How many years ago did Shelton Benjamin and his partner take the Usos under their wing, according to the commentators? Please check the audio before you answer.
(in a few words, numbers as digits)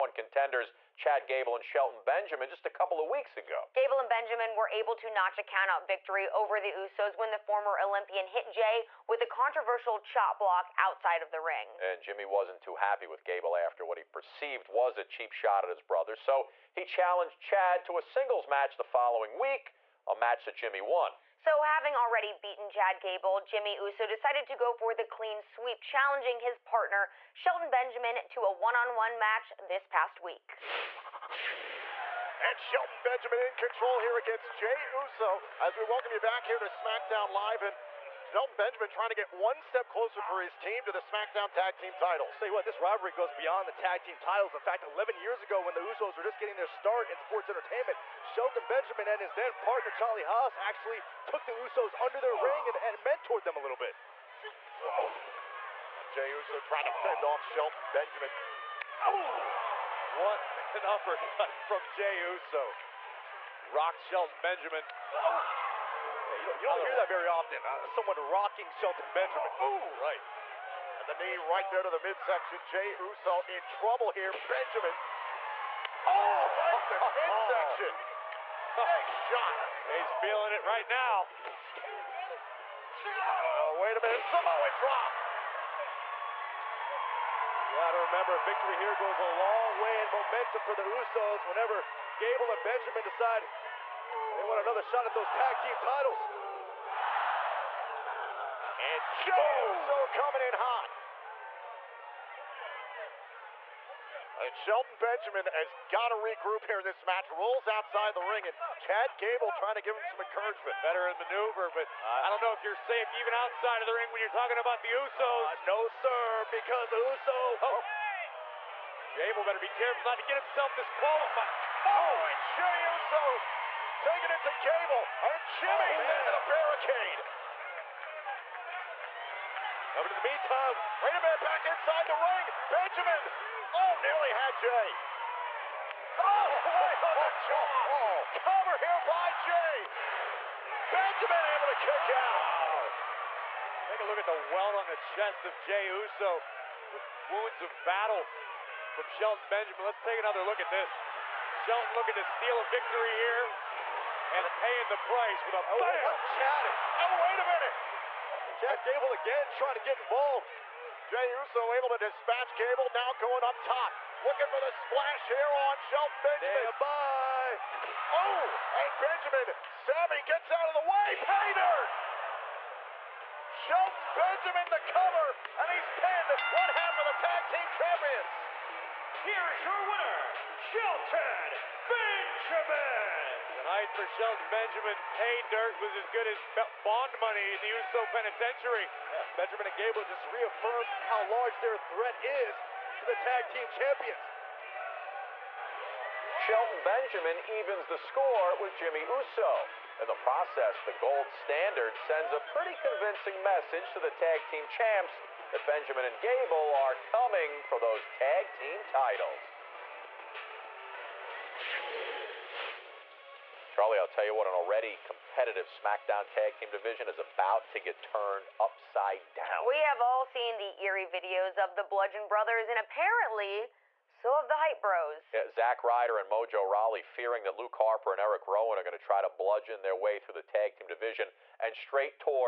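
11.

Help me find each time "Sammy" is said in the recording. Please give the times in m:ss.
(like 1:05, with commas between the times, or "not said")
2:49.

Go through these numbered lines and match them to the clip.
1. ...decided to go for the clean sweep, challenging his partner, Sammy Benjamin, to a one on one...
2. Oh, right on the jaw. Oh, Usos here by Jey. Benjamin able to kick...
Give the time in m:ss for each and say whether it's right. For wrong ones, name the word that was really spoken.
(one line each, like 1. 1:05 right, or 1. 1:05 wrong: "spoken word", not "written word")
1. 0:24 wrong: "Shelton", not "Sammy"
2. 2:16 wrong: "Cover", not "Usos".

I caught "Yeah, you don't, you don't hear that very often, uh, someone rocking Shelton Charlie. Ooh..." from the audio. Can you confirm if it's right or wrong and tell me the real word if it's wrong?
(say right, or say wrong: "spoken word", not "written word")
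wrong: "Benjamin", not "Charlie".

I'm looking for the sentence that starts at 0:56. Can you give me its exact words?
Jey Uso trying to fend off Shelton Benjamin.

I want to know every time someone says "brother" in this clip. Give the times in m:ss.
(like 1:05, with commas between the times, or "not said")
0:15, 3:42.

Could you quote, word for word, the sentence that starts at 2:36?
Chad, oh, oh, wait a minute!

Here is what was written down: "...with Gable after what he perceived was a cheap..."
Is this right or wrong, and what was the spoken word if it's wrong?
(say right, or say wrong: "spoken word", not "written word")
right.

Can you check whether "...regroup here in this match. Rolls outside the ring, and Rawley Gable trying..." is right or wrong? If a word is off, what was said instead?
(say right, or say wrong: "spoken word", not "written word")
wrong: "Chad", not "Rawley".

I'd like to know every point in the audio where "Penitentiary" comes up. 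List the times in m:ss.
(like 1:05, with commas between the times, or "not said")
3:08.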